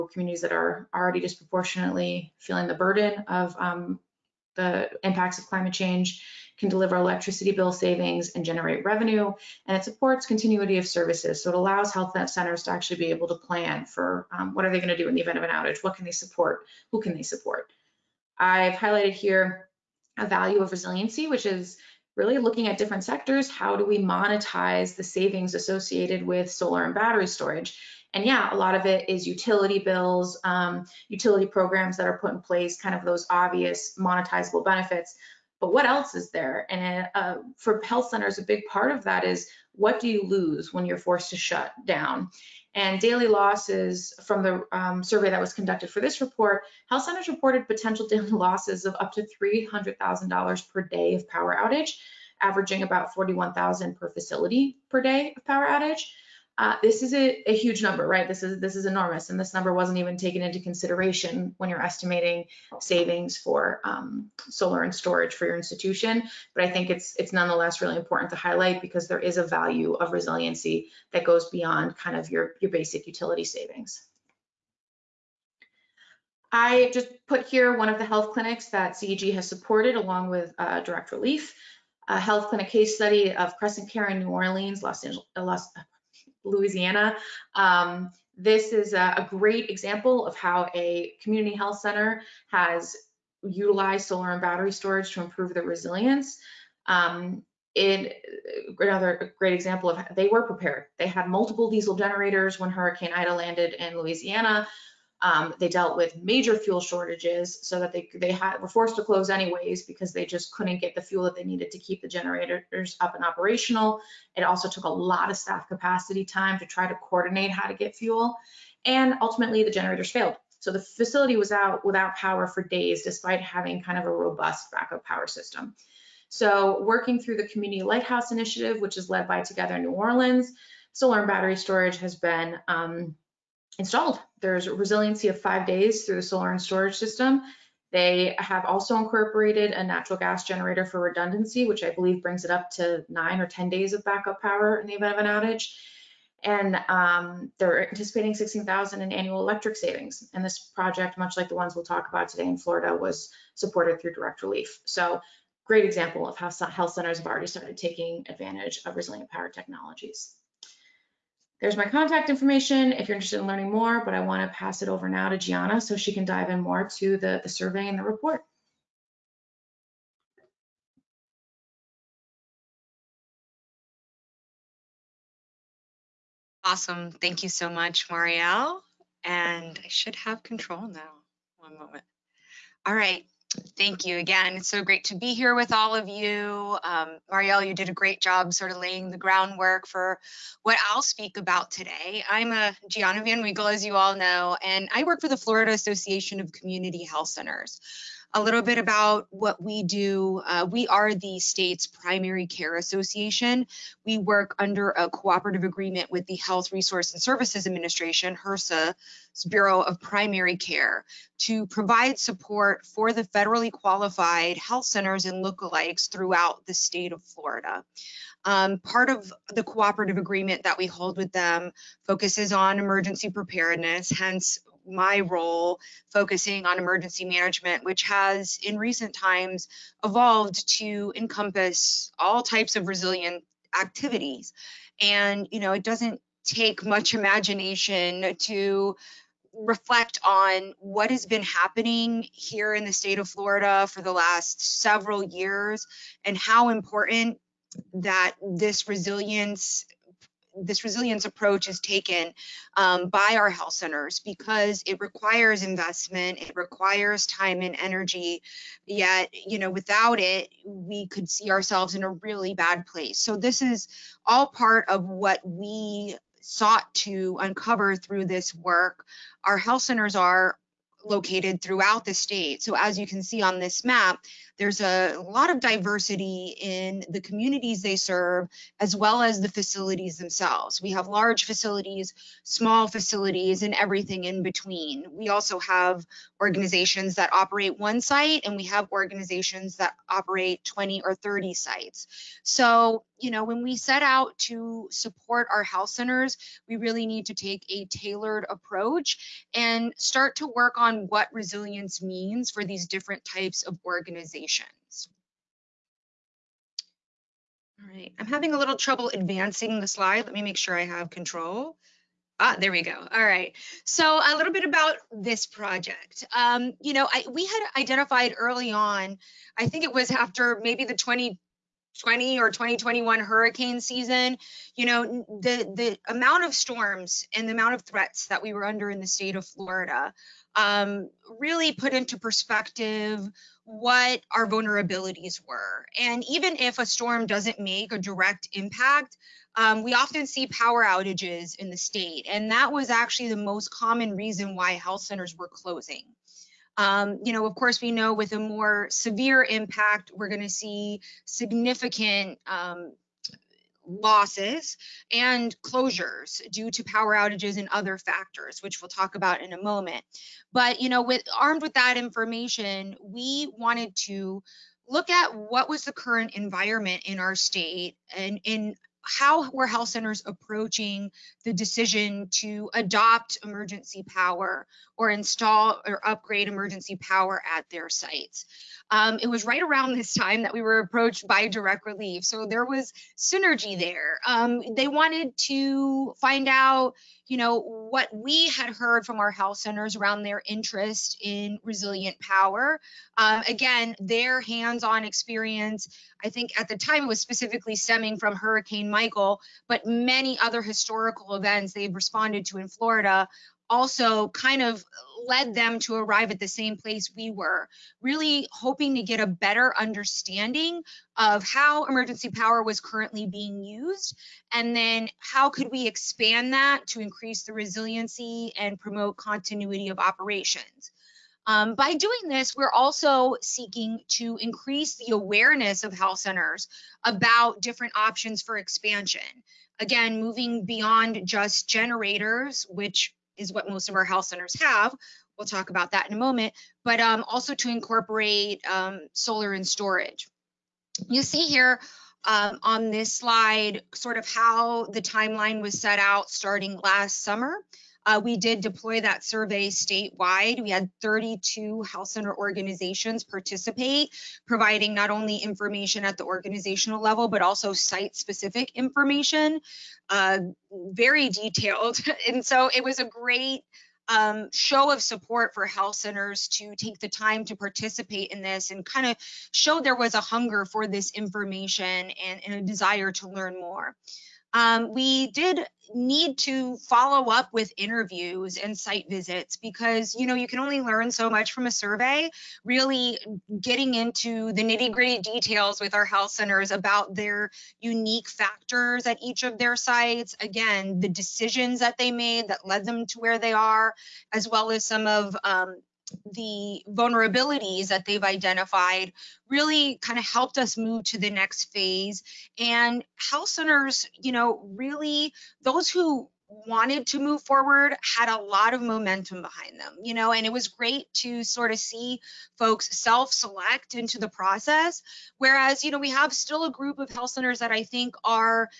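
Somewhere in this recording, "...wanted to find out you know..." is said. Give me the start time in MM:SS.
06:24.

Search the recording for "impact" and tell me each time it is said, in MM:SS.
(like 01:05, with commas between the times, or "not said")
00:05, 05:38, 05:49.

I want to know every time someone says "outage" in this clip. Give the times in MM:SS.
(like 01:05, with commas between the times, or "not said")
00:15, 00:51, 00:55, 02:25, 05:40, 05:57.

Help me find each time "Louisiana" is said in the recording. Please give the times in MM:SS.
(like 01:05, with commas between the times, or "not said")
01:26, 01:43.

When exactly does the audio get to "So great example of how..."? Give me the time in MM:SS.
02:34.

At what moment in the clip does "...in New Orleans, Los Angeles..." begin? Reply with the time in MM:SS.
01:24.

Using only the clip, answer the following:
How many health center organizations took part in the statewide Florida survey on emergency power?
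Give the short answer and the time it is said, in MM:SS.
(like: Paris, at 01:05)
32, at 07:31.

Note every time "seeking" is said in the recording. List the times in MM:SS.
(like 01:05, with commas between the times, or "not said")
07:03.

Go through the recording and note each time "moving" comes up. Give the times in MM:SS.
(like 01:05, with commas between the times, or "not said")
07:10.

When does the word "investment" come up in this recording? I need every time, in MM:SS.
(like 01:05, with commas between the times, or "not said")
04:15.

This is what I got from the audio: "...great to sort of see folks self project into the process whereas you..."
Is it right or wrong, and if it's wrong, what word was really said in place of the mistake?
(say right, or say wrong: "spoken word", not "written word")
wrong: "select", not "project".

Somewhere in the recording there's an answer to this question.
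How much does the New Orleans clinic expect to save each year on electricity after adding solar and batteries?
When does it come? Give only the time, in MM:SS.
02:28.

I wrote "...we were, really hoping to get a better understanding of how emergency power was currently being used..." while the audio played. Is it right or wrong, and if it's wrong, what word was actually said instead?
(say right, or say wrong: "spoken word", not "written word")
right.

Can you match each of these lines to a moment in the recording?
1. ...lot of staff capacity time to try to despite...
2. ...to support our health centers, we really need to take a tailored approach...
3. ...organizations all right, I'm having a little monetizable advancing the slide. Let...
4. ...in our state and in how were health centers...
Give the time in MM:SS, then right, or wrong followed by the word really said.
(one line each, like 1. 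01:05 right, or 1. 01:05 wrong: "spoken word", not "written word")
1. 01:54 wrong: "coordinate", not "despite"
2. 04:54 right
3. 05:03 wrong: "trouble", not "monetizable"
4. 06:07 right.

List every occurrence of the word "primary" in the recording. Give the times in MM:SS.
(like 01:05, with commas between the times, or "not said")
03:21, 03:30.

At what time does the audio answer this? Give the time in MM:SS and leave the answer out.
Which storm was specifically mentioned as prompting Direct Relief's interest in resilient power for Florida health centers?
06:38.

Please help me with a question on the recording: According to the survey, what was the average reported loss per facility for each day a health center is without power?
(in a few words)
$41,000.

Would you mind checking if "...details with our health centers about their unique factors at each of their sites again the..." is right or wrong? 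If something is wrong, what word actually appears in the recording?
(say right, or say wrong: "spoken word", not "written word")
right.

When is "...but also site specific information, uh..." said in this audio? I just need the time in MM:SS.
07:37.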